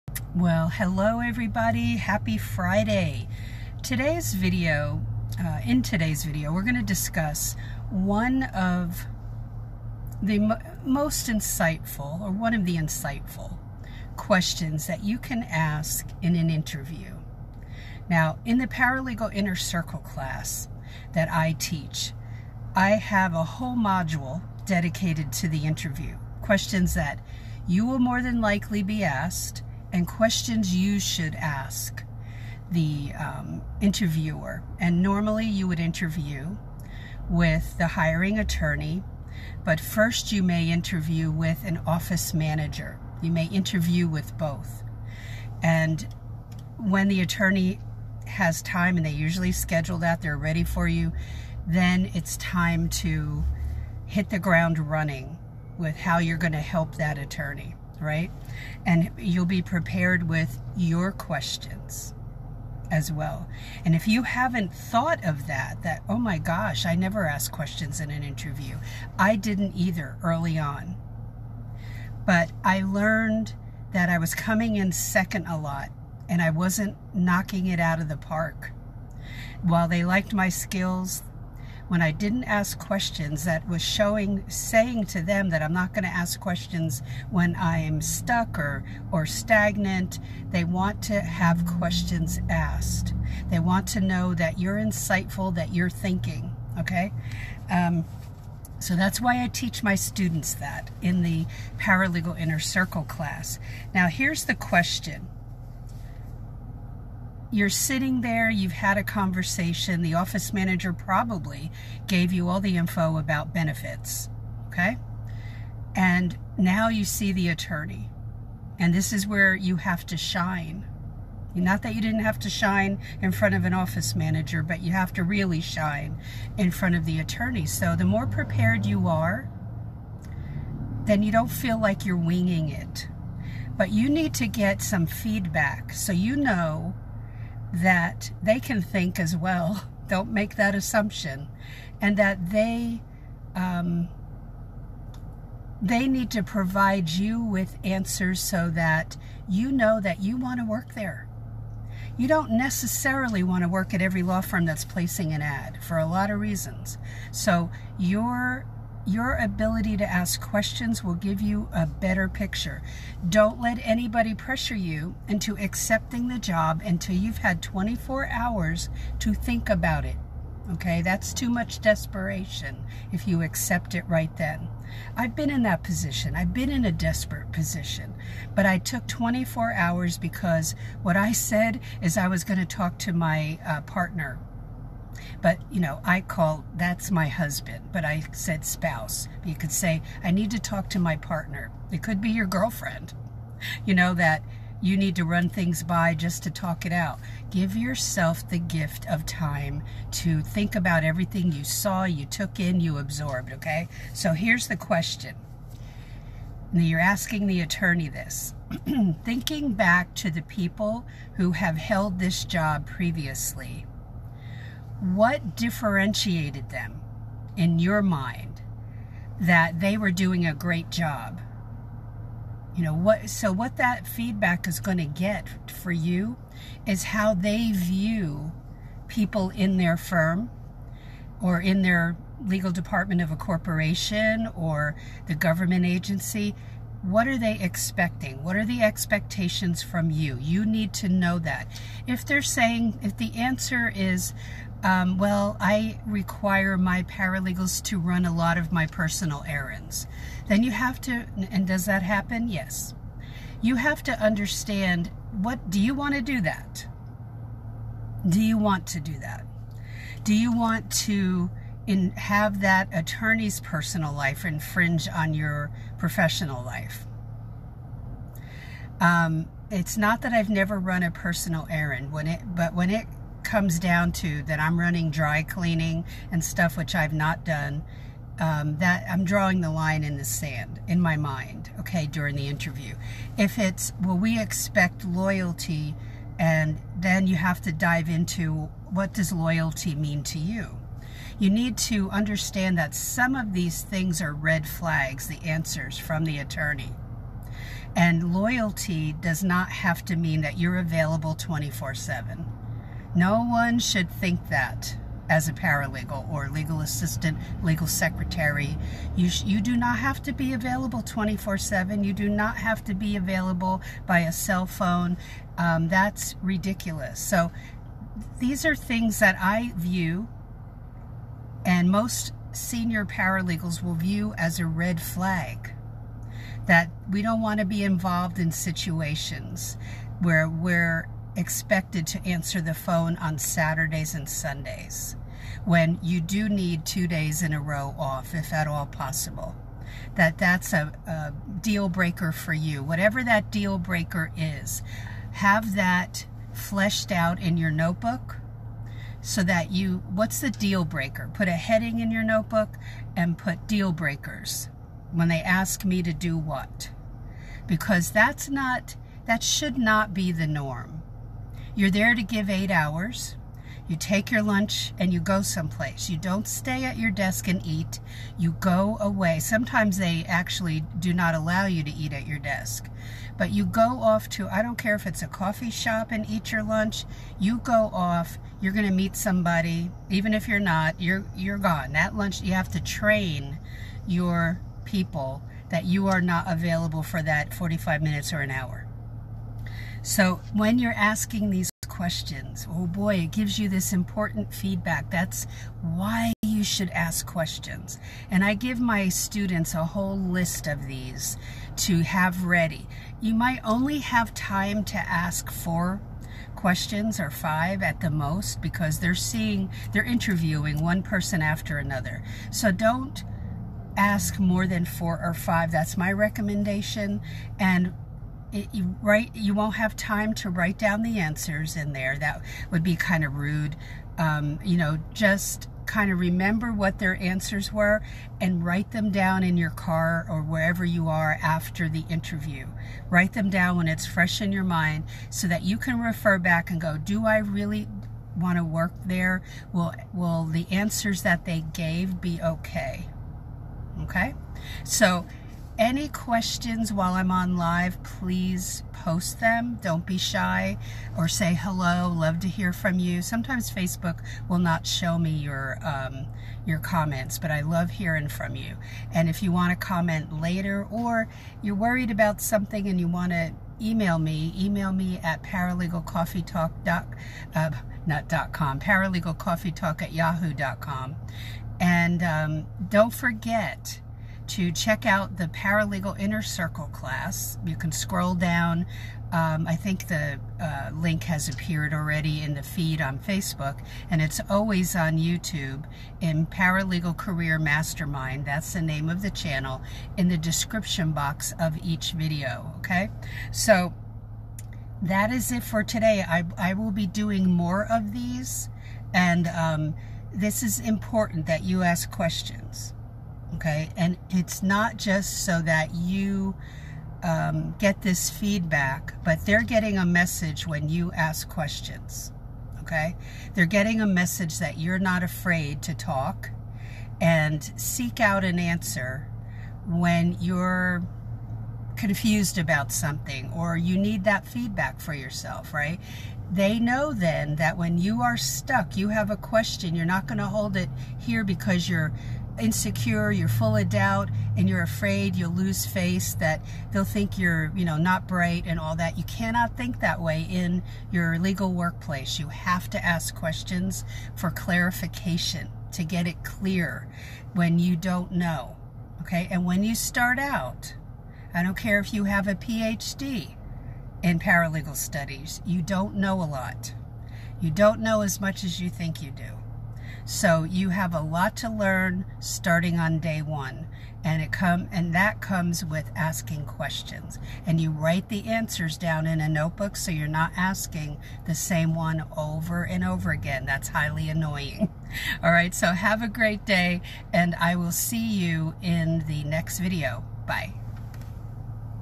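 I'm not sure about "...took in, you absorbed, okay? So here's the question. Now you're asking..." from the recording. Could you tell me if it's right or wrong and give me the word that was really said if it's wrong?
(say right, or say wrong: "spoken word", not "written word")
right.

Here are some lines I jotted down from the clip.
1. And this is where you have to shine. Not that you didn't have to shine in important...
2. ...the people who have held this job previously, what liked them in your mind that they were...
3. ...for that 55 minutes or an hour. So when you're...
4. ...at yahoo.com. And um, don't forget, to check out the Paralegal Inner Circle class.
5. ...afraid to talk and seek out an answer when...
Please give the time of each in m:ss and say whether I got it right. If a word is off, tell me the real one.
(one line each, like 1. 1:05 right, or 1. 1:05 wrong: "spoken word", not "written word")
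1. 1:58 wrong: "front", not "important"
2. 3:30 wrong: "differentiated", not "liked"
3. 6:27 wrong: "45", not "55"
4. 7:50 right
5. 8:35 right.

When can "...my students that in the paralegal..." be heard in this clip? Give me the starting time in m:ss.
1:39.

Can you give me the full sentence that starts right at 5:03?
No one should think that as a paralegal or legal assistant, legal secretary.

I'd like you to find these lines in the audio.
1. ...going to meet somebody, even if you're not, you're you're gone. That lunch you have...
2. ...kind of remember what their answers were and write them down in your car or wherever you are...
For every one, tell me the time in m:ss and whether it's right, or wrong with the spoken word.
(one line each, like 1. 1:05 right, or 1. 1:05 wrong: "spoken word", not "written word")
1. 6:18 right
2. 7:05 right.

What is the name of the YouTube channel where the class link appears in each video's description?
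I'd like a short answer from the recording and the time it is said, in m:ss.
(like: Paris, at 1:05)
Paralegal Career Mastermind, at 8:06.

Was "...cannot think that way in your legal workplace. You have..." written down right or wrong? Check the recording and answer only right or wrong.
right.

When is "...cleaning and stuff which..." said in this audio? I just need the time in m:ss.
4:35.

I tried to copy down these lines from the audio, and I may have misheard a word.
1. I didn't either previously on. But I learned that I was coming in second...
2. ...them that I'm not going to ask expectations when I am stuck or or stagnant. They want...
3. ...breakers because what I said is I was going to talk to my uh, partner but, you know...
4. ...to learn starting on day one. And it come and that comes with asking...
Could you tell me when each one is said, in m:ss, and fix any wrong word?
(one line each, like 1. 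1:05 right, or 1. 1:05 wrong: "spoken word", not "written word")
1. 1:09 wrong: "early", not "previously"
2. 1:25 wrong: "questions", not "expectations"
3. 2:59 wrong: "hours", not "breakers"
4. 9:21 right.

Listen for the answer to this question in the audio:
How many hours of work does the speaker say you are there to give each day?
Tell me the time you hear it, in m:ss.
6:02.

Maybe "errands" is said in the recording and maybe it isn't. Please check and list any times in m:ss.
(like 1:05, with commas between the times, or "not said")
4:09, 4:31.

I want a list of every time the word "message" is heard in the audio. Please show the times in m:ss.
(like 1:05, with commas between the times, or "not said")
8:30, 8:34.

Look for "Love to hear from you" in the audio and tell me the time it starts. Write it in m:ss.
7:32.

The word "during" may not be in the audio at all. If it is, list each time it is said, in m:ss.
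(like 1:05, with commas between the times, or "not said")
4:42.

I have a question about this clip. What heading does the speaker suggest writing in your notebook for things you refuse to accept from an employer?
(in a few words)
deal breakers.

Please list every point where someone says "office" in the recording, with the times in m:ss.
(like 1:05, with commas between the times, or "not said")
0:41, 1:50, 2:03.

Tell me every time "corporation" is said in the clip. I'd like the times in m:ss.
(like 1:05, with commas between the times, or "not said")
3:53.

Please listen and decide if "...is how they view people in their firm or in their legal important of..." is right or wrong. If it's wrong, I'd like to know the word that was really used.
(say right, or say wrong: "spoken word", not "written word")
wrong: "department", not "important".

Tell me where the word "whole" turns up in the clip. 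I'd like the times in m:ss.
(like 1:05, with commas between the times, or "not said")
0:23, 6:39.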